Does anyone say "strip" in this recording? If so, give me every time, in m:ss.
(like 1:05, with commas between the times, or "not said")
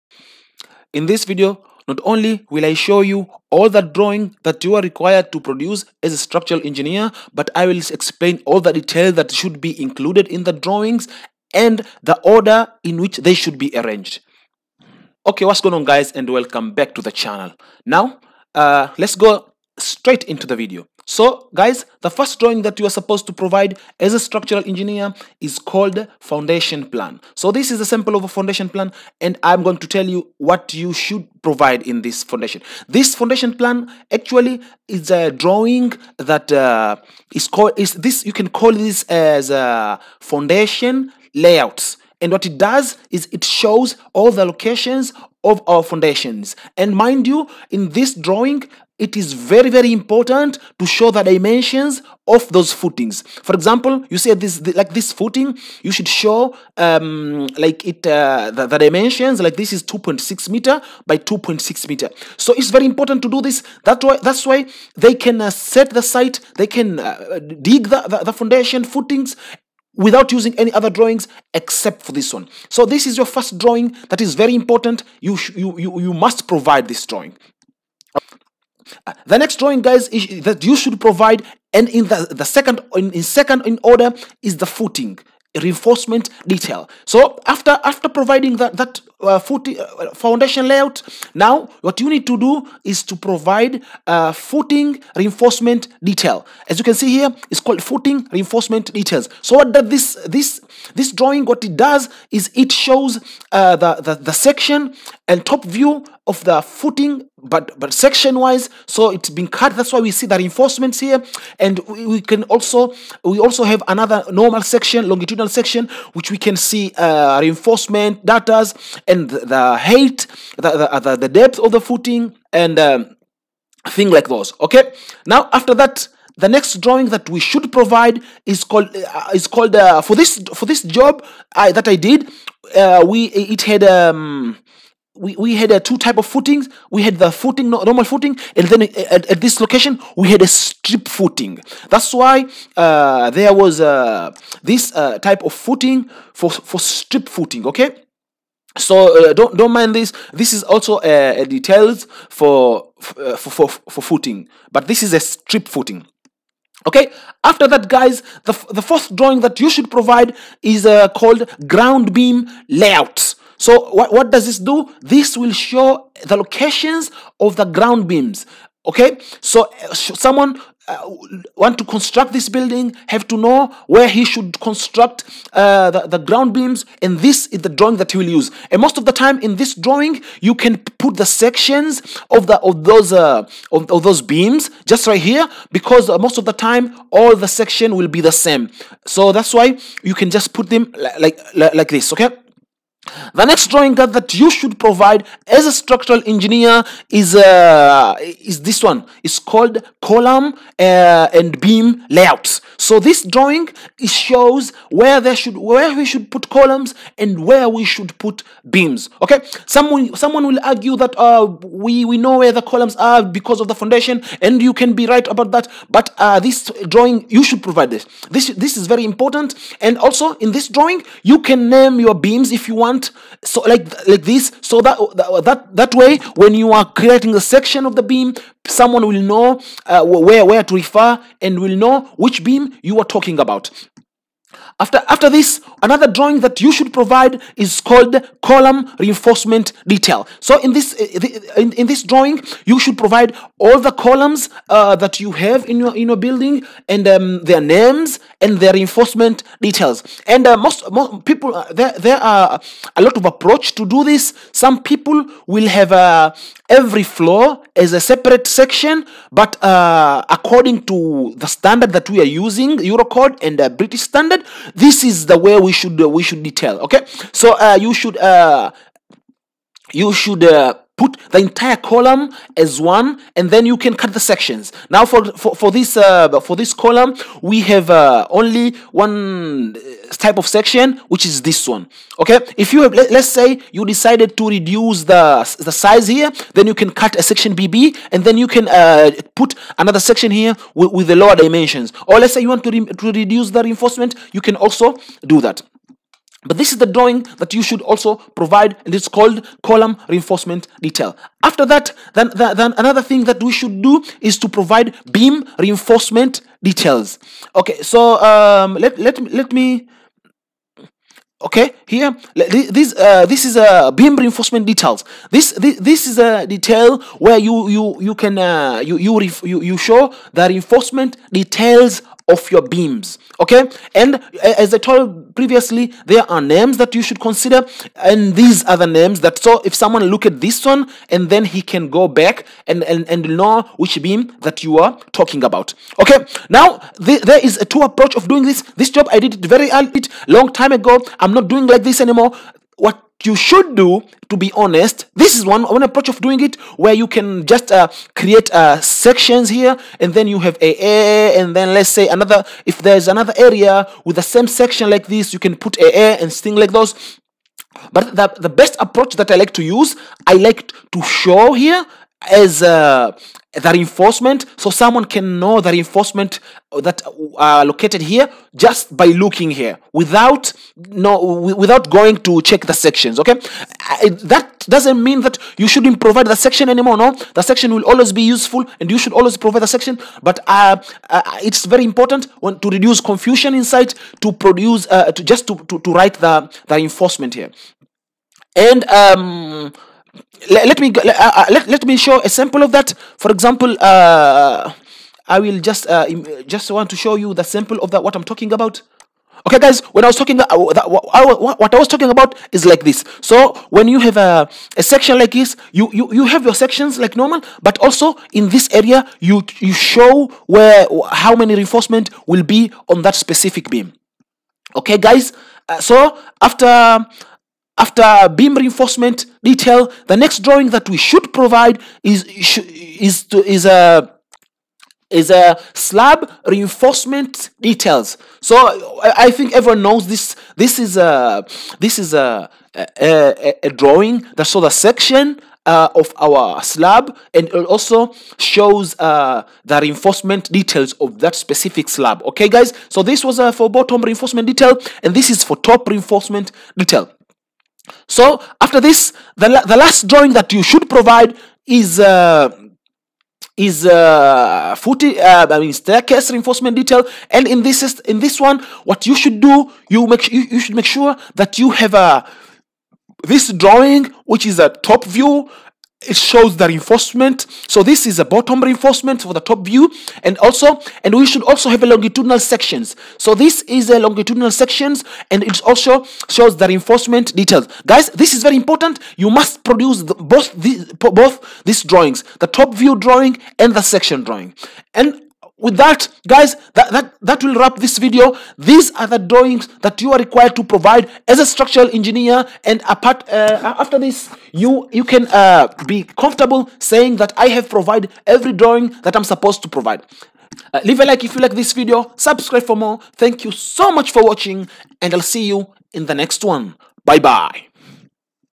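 2:20, 2:26, 2:35.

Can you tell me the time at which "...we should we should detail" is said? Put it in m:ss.
4:25.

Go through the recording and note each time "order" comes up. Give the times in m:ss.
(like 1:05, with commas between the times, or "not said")
0:12, 1:23.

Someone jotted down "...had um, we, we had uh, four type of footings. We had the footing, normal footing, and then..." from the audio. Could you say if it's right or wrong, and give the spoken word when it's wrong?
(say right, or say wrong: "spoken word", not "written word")
wrong: "two", not "four".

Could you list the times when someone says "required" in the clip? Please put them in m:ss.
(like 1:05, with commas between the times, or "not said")
0:04, 8:10.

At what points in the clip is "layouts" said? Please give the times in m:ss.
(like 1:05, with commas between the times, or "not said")
0:41, 1:30, 2:42, 3:22.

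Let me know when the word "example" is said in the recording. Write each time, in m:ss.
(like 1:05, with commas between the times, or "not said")
0:53, 6:33.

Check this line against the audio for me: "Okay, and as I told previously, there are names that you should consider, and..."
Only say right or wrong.
right.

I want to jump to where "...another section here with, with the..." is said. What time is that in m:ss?
4:49.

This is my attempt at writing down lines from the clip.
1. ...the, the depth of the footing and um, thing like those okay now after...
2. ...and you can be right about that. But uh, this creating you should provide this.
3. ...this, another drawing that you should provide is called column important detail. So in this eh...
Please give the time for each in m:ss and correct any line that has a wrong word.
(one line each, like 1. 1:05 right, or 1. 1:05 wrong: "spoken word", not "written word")
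1. 2:00 right
2. 3:34 wrong: "drawing", not "creating"
3. 3:55 wrong: "reinforcement", not "important".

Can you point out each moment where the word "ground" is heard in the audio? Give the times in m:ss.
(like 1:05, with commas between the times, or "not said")
2:41, 2:47, 2:56.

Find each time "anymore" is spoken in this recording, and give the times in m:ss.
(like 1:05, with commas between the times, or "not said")
5:42, 6:16.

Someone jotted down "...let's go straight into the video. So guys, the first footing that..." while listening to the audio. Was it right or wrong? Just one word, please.
wrong.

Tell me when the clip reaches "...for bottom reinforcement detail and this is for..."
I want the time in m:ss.
7:23.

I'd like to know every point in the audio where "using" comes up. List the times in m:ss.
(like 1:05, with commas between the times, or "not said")
1:10, 4:22.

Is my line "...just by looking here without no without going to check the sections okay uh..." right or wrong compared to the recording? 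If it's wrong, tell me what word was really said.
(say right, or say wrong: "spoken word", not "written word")
right.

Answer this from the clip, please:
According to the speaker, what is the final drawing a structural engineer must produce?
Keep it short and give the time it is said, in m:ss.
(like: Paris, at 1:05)
staircase reinforcement detail, at 7:35.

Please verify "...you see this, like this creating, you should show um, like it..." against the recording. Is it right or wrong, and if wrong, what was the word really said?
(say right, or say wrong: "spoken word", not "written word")
wrong: "footing", not "creating".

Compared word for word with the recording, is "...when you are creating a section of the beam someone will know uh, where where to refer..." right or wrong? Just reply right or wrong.
right.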